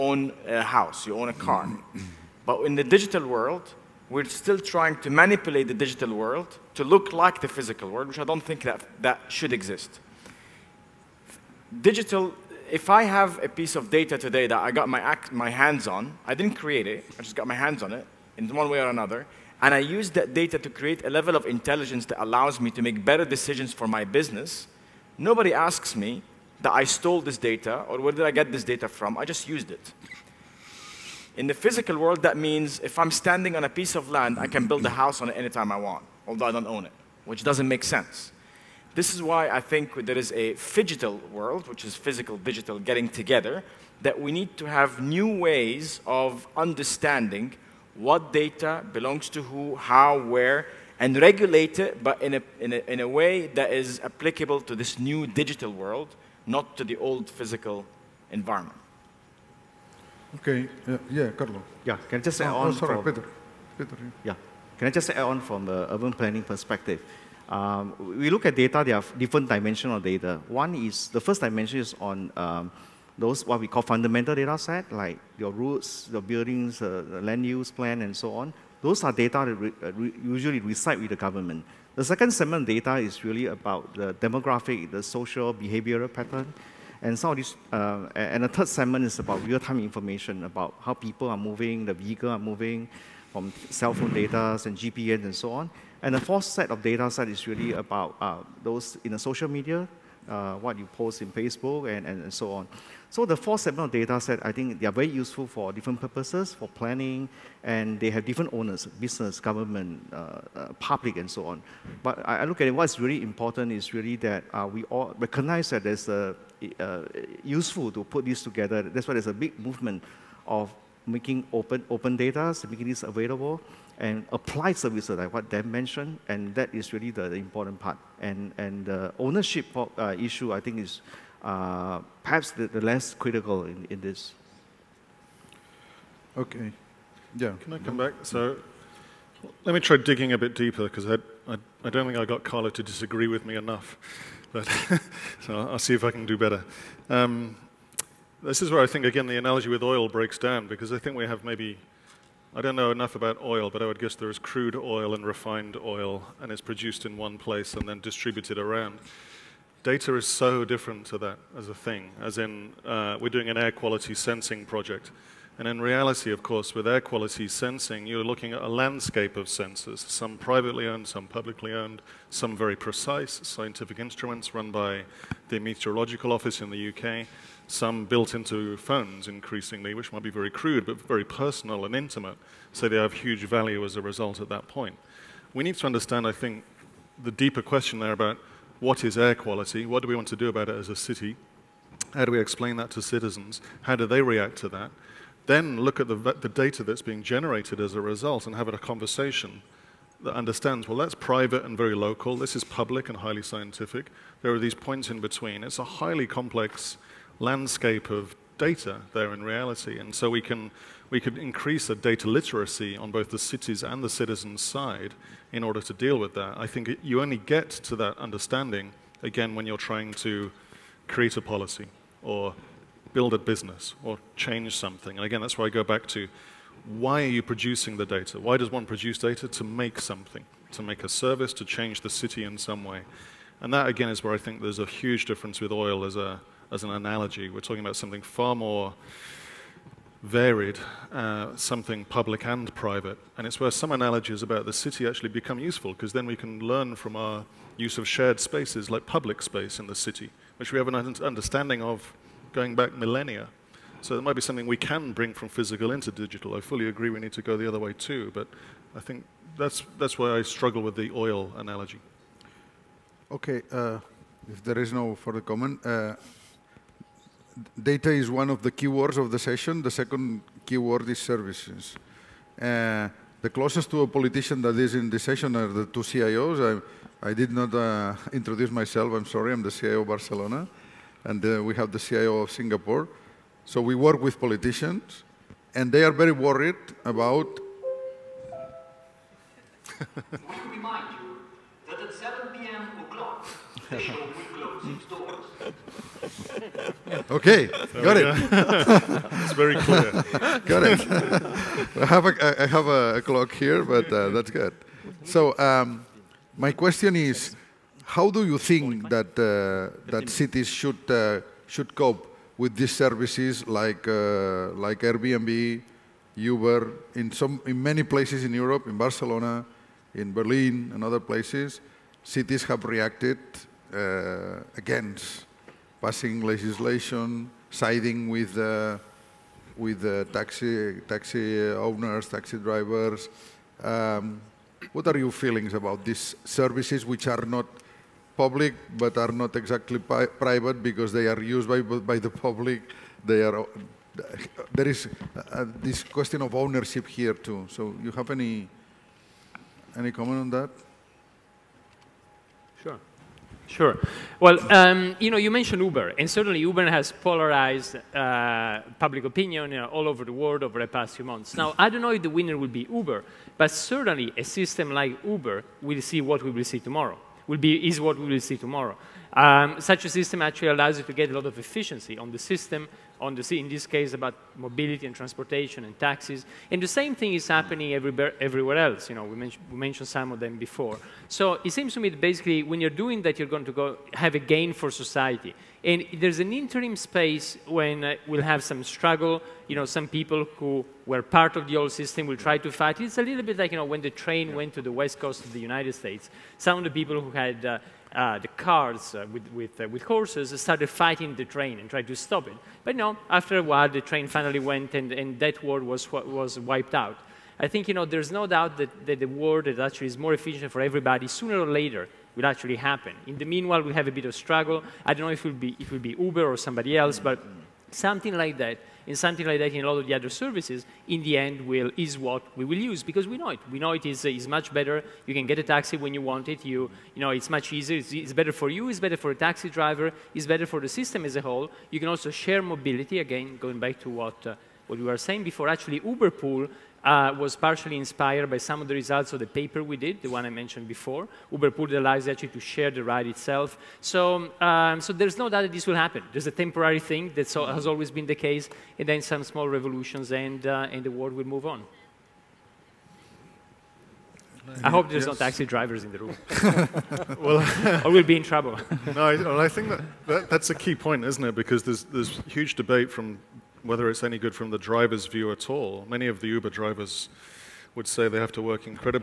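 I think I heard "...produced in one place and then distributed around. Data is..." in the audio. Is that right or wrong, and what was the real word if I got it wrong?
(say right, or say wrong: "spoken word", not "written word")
right.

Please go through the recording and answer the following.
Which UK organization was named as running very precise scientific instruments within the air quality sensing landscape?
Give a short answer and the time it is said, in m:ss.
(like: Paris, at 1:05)
Meteorological Office, at 2:55.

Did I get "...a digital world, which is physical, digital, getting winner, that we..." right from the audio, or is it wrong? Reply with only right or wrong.
wrong.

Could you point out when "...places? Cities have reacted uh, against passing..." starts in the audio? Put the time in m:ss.
5:21.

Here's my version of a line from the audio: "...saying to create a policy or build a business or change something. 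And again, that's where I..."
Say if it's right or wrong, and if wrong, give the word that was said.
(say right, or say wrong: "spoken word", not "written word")
wrong: "trying", not "saying".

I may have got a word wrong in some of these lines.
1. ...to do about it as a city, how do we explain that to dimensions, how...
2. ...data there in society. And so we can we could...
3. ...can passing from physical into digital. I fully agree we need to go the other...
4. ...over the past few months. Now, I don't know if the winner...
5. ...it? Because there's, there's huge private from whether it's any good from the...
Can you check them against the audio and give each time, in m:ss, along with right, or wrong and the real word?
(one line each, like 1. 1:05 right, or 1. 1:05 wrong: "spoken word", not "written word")
1. 3:10 wrong: "citizens", not "dimensions"
2. 3:28 wrong: "reality", not "society"
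3. 4:14 wrong: "bring", not "passing"
4. 6:00 right
5. 7:41 wrong: "debate", not "private".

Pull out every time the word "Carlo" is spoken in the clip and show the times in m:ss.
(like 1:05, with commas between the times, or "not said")
1:01, 2:22.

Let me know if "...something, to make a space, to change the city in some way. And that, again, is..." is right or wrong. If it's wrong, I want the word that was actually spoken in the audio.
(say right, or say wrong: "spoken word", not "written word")
wrong: "service", not "space".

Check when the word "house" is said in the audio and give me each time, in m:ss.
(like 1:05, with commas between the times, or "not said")
0:00, 0:34.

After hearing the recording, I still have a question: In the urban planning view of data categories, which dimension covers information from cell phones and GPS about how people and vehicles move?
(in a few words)
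third segment.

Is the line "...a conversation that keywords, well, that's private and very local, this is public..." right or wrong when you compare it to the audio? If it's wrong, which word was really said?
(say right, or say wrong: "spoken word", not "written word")
wrong: "understands", not "keywords".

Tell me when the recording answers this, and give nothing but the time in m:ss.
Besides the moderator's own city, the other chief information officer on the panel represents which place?
4:41.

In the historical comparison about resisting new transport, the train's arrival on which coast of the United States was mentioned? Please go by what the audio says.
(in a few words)
West coast.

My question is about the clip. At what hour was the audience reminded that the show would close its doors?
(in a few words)
7 p.m.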